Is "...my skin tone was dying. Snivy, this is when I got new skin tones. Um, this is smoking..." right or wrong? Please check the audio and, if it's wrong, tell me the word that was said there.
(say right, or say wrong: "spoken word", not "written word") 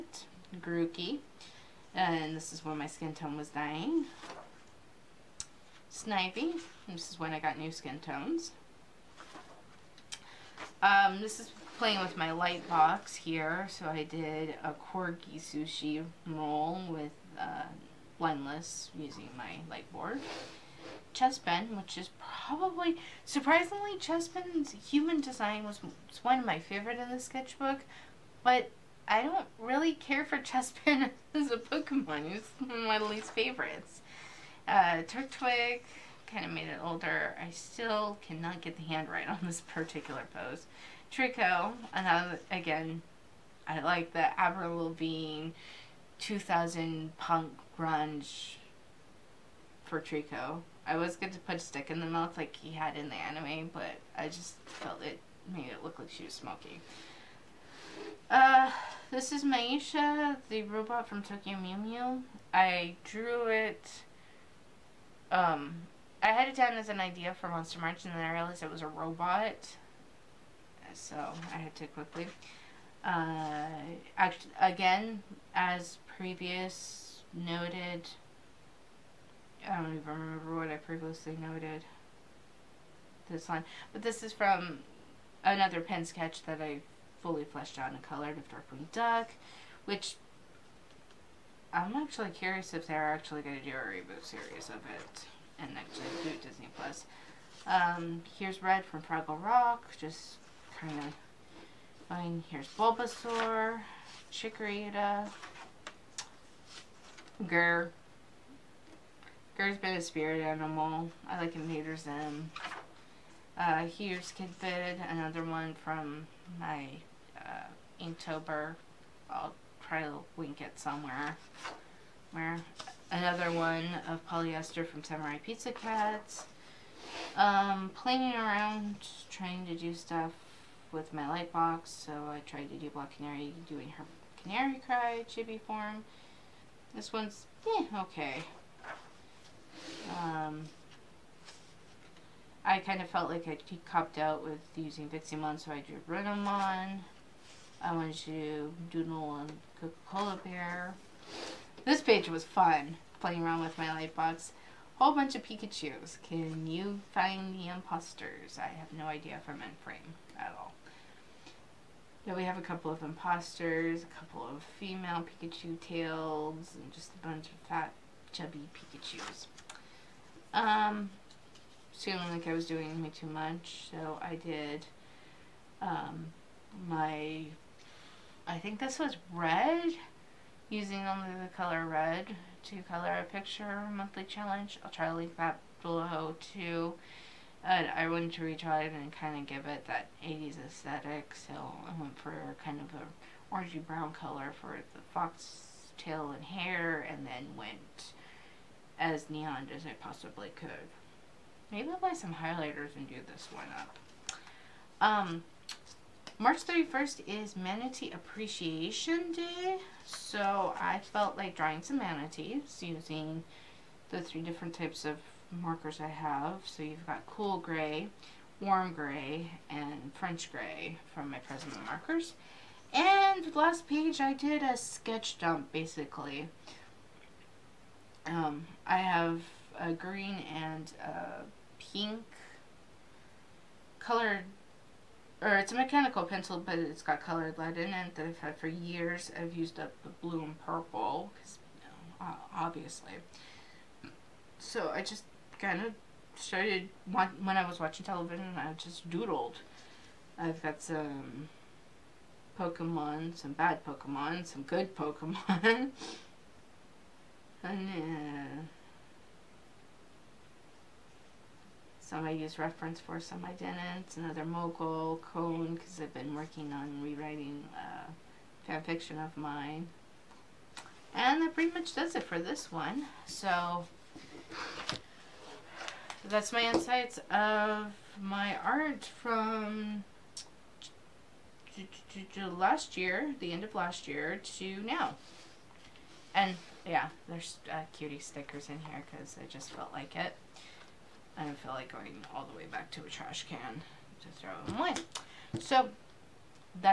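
wrong: "playing", not "smoking".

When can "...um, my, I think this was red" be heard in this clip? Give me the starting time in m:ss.
2:55.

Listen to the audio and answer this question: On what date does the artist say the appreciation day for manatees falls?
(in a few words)
March 31st.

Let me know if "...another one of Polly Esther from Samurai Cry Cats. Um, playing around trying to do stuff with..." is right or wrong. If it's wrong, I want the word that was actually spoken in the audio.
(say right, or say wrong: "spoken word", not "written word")
wrong: "Pizza", not "Cry".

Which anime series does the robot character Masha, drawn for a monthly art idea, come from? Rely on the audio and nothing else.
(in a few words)
Tokyo Mew Mew.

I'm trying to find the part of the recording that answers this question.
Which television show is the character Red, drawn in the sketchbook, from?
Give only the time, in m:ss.
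1:39.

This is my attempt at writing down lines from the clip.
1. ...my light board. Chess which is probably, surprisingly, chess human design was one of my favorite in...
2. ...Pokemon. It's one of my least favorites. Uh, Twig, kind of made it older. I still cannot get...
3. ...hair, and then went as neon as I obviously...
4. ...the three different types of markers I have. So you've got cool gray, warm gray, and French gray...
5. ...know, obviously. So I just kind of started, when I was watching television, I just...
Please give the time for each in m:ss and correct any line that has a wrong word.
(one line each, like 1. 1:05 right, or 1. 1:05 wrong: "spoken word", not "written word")
1. 0:19 right
2. 0:31 right
3. 3:16 wrong: "possibly", not "obviously"
4. 3:34 right
5. 4:02 right.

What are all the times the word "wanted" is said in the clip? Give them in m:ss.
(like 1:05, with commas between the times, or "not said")
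2:27, 3:08.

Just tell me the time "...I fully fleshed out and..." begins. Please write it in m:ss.
1:26.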